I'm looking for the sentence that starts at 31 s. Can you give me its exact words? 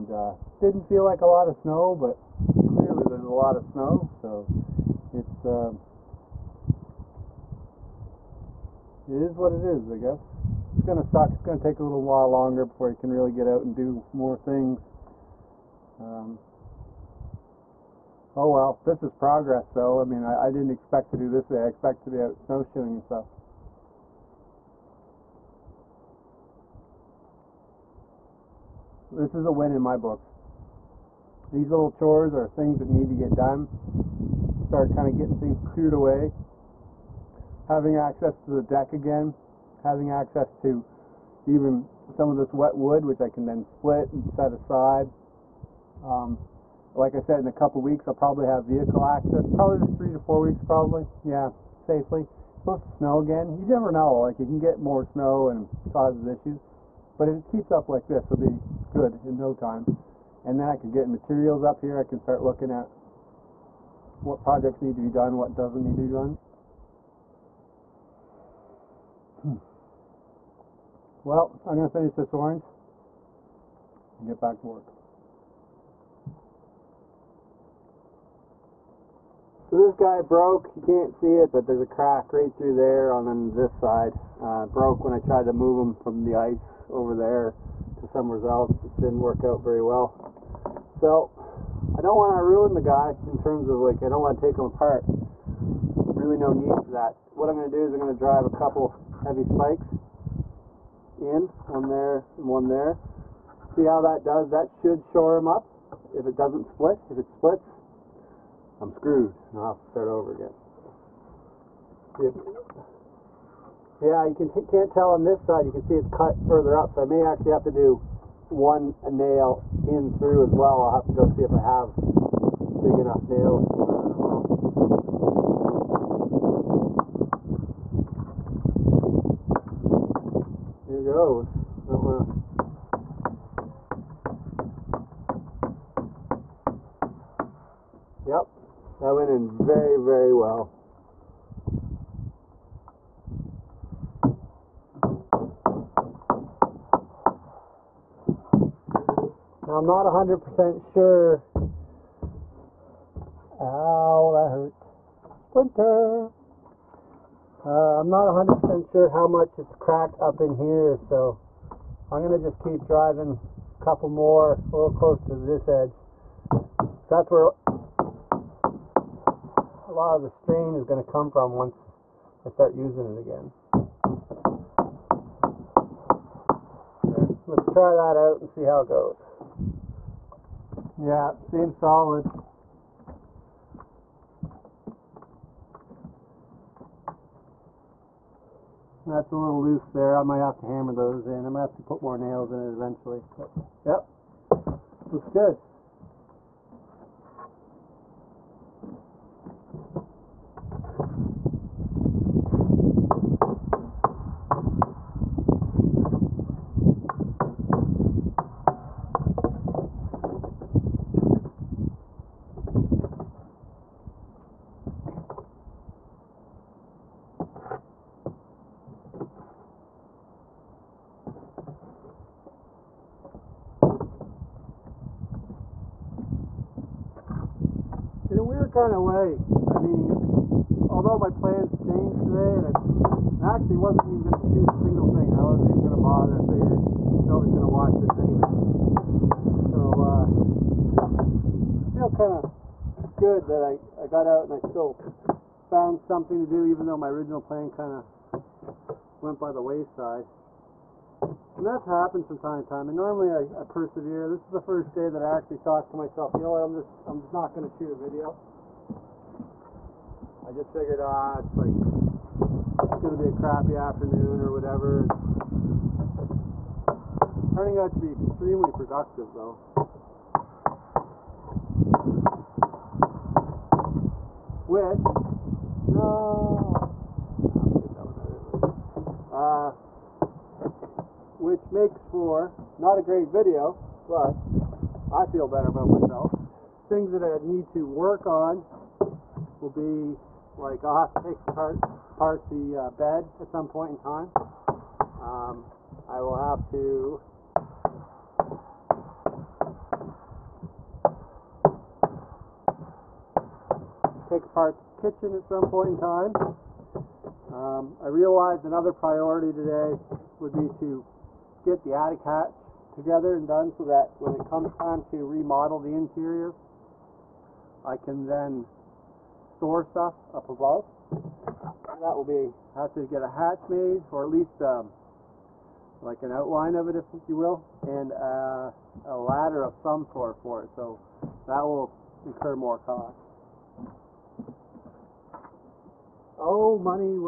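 These little chores are things that need to get done.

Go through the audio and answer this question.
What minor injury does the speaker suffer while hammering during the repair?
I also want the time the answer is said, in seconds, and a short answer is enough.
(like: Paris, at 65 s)
splinter, at 155 s.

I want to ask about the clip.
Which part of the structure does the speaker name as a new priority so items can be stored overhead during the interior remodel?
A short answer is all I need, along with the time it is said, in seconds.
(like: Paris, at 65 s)
attic hatch, at 311 s.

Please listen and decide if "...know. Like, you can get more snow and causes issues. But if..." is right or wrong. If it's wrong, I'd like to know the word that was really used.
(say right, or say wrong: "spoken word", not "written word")
right.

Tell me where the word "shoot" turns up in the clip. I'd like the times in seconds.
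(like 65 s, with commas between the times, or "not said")
234 s, 257 s.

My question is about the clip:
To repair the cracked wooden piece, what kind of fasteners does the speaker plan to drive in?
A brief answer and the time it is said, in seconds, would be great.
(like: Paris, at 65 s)
heavy spikes, at 99 s.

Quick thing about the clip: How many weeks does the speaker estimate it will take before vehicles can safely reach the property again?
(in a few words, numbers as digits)
3 to 4 weeks.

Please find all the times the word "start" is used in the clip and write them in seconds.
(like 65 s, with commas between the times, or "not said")
34 s, 62 s, 109 s, 172 s.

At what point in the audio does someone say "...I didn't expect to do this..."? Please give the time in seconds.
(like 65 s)
20 s.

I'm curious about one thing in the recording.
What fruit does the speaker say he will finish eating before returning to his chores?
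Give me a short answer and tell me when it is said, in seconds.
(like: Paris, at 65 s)
orange, at 72 s.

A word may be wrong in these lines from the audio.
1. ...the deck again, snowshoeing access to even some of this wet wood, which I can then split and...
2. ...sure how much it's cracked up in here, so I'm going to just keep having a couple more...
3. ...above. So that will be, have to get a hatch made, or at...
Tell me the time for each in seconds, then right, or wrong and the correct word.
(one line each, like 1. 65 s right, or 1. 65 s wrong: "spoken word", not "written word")
1. 38 s wrong: "having", not "snowshoeing"
2. 158 s wrong: "driving", not "having"
3. 320 s right.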